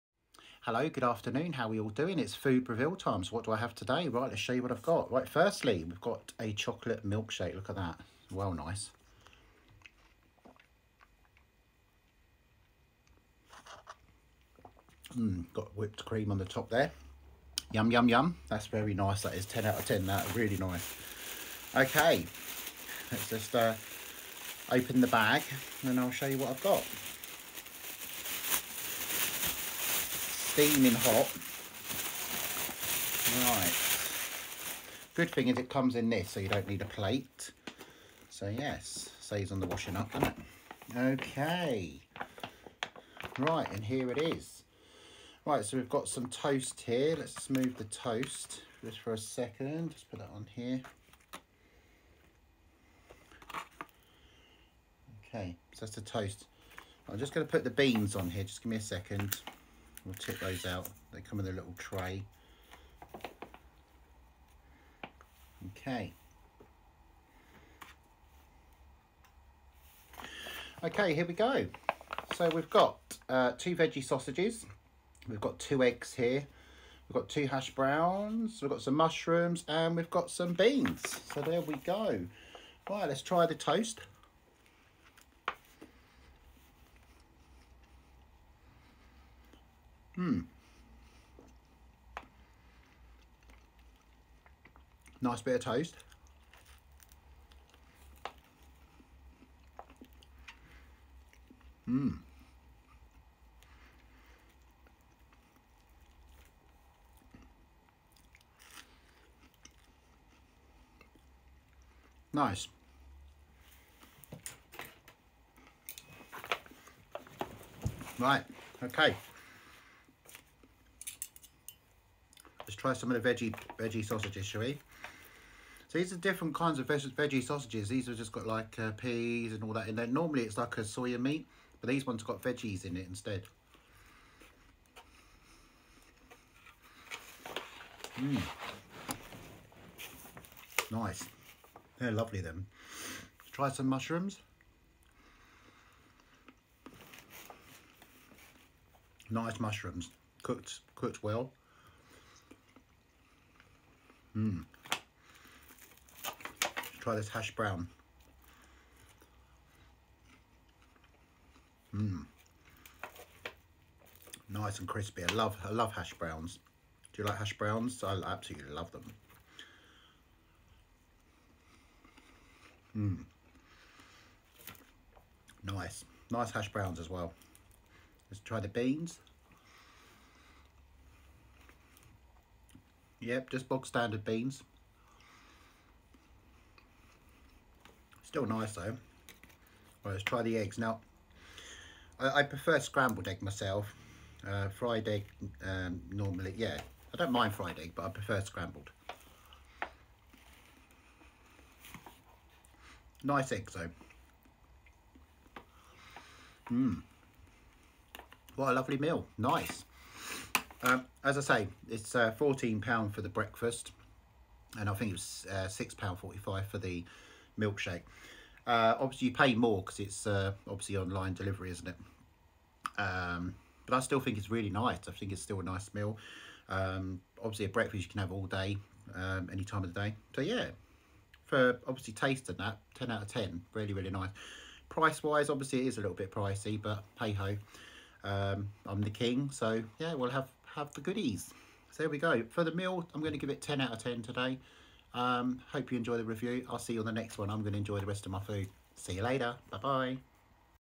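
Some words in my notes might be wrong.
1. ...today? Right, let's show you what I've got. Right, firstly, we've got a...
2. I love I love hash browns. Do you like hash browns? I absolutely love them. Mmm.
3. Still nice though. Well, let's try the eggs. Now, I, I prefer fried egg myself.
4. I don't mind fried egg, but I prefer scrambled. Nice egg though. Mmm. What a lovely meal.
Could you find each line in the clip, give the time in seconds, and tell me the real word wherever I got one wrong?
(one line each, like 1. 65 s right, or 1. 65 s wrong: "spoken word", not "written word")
1. 3 s right
2. 165 s right
3. 188 s wrong: "scrambled", not "fried"
4. 197 s right.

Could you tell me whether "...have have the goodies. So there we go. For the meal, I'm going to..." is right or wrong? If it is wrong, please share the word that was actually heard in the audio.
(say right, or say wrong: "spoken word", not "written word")
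right.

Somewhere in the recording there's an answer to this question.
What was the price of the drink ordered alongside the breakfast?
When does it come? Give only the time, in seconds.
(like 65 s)
215 s.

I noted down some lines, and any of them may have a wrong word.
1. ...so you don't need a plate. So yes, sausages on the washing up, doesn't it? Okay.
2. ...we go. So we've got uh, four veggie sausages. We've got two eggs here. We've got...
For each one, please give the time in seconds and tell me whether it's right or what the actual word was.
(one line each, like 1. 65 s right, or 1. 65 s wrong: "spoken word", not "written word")
1. 36 s wrong: "saves", not "sausages"
2. 71 s wrong: "two", not "four".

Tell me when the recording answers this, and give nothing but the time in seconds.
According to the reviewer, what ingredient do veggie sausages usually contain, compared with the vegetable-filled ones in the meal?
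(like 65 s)
130 s.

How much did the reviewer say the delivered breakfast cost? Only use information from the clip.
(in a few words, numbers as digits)
£14.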